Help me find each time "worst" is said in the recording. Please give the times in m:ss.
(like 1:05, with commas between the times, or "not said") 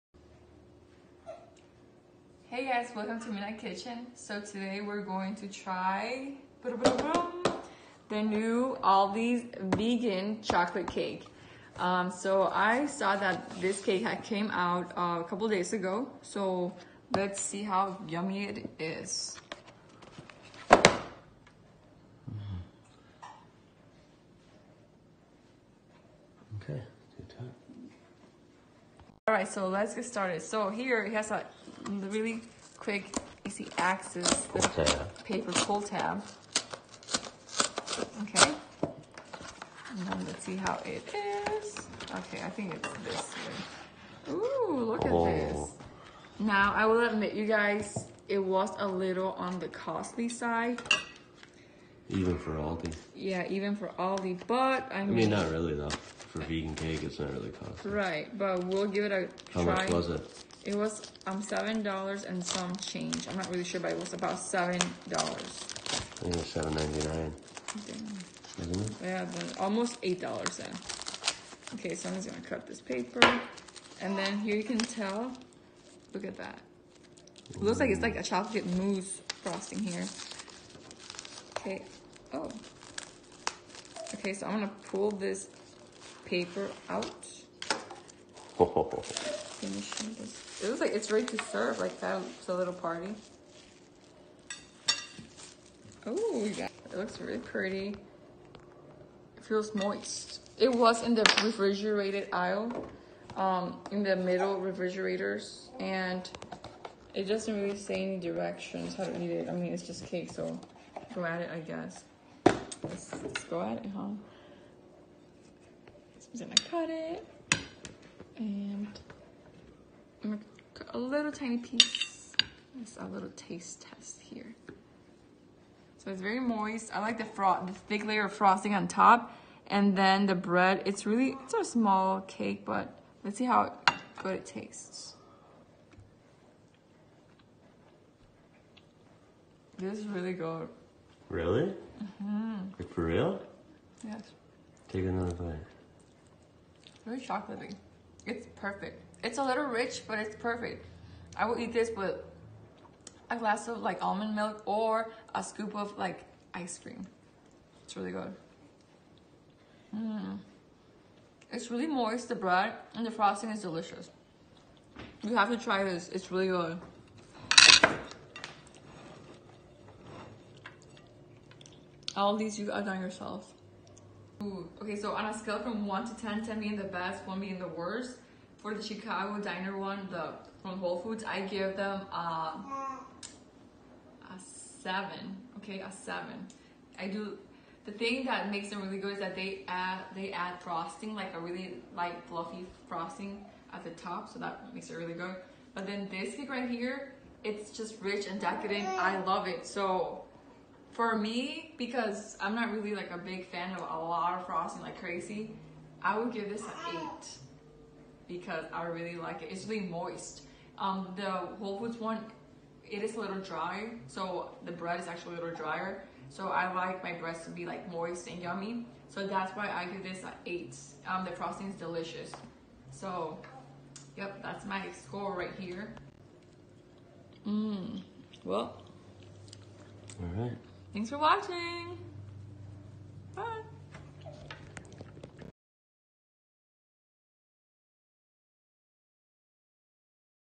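2:57.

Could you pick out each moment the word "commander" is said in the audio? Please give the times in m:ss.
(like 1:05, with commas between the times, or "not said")
not said.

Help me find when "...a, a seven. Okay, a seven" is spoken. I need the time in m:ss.
3:02.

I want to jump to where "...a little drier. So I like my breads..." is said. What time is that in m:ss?
3:35.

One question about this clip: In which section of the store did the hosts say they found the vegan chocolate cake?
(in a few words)
refrigerated aisle.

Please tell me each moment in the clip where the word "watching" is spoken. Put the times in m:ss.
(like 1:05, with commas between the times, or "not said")
3:51.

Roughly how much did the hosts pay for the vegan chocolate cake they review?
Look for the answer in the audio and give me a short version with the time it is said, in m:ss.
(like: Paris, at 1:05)
$7.99, at 1:06.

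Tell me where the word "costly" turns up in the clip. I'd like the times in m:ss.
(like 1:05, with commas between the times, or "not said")
0:49, 0:57.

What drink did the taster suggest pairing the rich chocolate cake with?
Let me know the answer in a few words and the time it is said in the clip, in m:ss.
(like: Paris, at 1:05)
almond milk, at 2:34.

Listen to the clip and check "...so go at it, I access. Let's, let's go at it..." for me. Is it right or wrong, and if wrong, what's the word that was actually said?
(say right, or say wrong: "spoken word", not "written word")
wrong: "guess", not "access".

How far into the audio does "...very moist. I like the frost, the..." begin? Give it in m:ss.
2:06.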